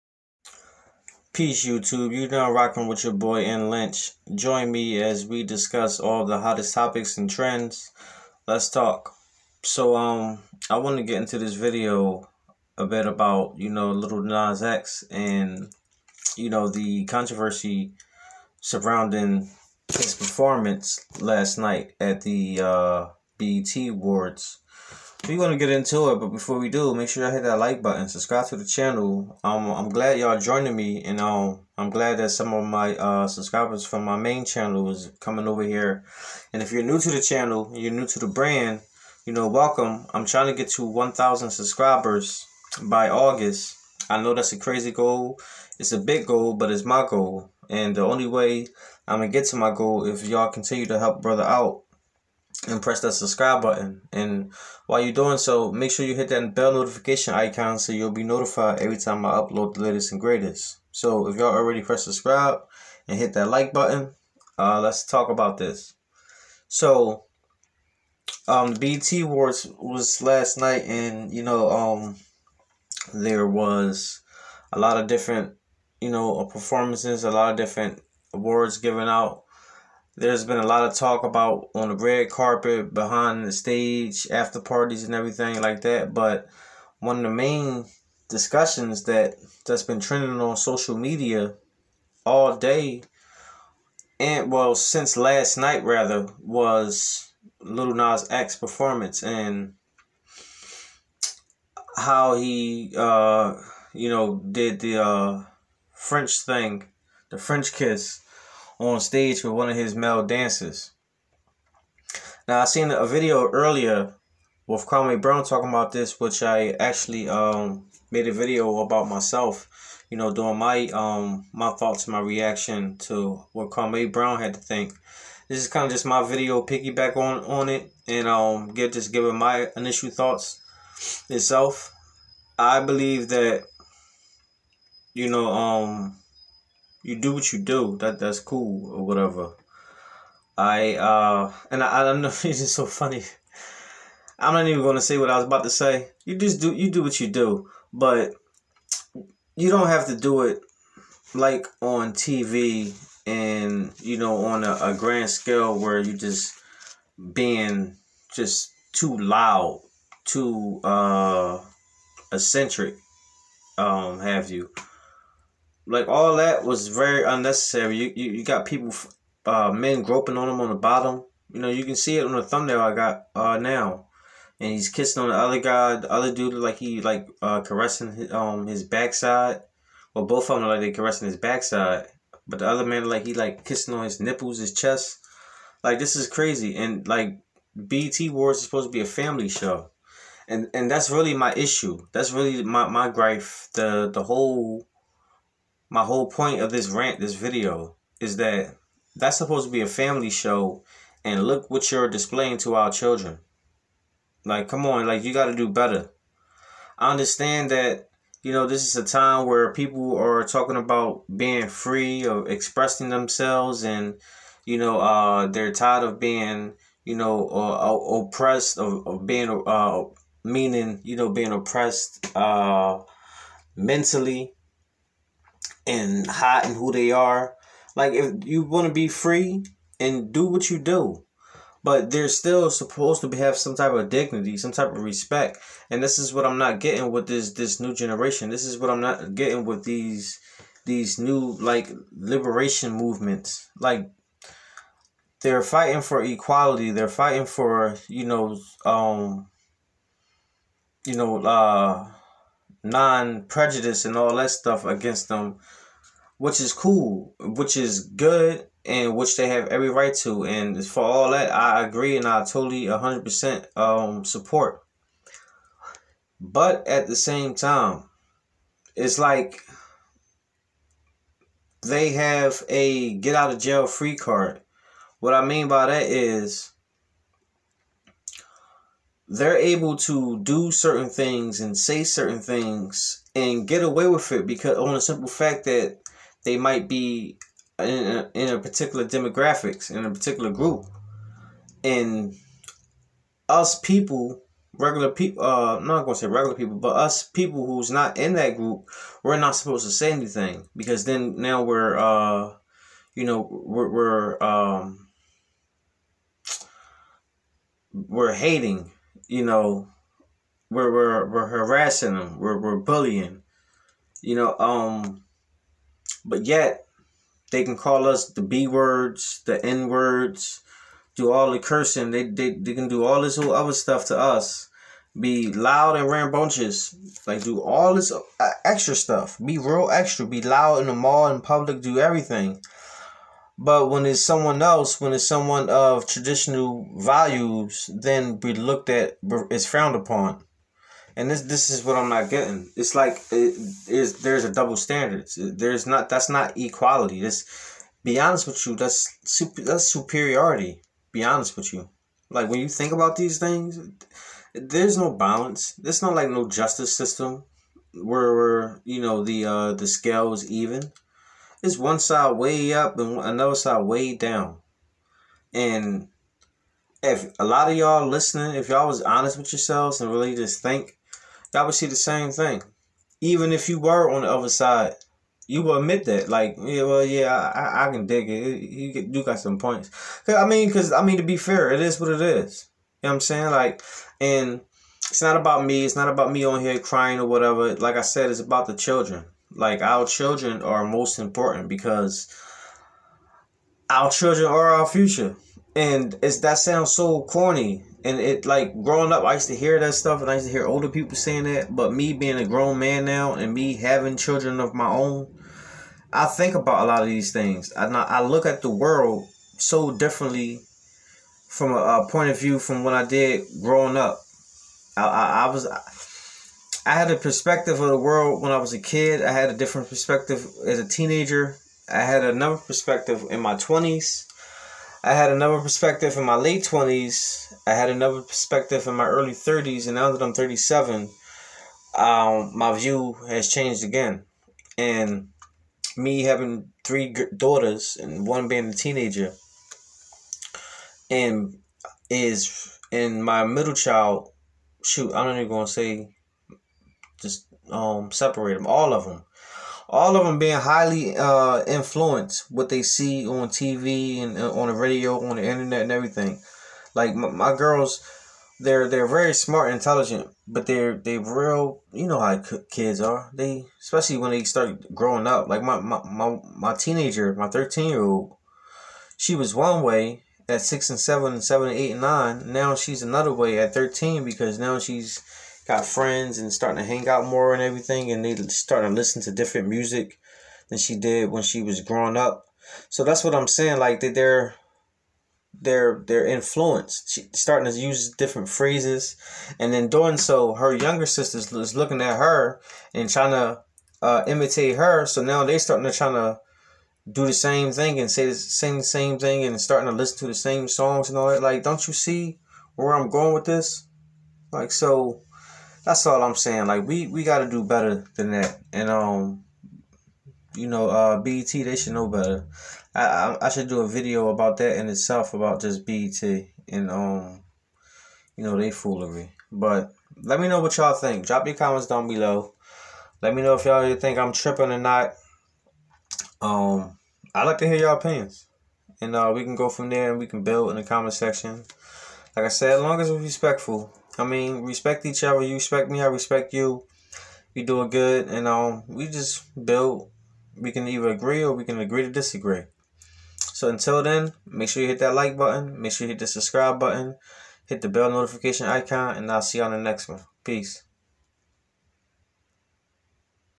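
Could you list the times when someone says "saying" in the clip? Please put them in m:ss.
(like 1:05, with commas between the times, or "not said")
6:23, 6:41, 8:03, 8:26.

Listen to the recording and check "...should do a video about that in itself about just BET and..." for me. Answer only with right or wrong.
right.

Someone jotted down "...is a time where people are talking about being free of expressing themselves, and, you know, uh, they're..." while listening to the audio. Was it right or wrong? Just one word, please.
right.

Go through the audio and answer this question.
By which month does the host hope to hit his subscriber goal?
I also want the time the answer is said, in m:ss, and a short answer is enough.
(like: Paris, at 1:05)
August, at 0:43.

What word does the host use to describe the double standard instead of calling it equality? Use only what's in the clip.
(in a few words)
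superiority.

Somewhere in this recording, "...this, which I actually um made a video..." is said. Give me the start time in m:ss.
1:55.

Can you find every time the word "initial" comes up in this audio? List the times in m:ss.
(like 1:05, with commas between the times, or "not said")
2:09.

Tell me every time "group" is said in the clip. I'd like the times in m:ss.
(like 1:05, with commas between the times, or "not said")
4:50, 4:58.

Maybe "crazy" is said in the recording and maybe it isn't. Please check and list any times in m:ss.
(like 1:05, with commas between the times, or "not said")
0:44, 3:06.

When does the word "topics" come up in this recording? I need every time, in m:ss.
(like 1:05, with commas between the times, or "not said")
0:06.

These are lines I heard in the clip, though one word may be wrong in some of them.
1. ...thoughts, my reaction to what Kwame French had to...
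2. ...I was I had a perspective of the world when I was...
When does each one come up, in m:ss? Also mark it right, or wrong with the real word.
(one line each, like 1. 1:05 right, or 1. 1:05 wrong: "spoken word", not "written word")
1. 2:01 wrong: "Brown", not "French"
2. 6:55 right.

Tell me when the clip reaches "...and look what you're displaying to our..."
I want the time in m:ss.
3:21.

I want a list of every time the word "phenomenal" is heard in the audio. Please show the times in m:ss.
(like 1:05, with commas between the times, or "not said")
not said.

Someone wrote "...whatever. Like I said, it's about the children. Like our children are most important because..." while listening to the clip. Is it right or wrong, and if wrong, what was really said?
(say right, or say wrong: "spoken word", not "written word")
right.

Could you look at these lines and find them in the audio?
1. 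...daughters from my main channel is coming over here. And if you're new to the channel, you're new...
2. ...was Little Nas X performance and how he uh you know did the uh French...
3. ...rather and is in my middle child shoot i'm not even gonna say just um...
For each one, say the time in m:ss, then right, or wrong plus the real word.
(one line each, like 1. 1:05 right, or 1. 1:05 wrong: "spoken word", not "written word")
1. 0:33 wrong: "subscribers", not "daughters"
2. 1:36 right
3. 7:18 wrong: "teenager", not "rather".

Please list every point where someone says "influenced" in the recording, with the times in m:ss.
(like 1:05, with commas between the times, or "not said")
7:31, 8:06.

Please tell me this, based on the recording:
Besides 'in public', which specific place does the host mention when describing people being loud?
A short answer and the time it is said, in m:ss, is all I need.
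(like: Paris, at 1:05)
the mall, at 5:30.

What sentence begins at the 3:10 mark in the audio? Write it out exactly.
And, and that's really my issue.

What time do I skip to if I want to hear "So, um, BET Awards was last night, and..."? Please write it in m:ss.
1:06.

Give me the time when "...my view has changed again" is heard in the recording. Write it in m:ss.
7:12.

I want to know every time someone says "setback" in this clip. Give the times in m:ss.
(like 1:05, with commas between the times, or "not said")
not said.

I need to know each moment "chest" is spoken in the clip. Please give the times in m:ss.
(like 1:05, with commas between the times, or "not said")
3:04.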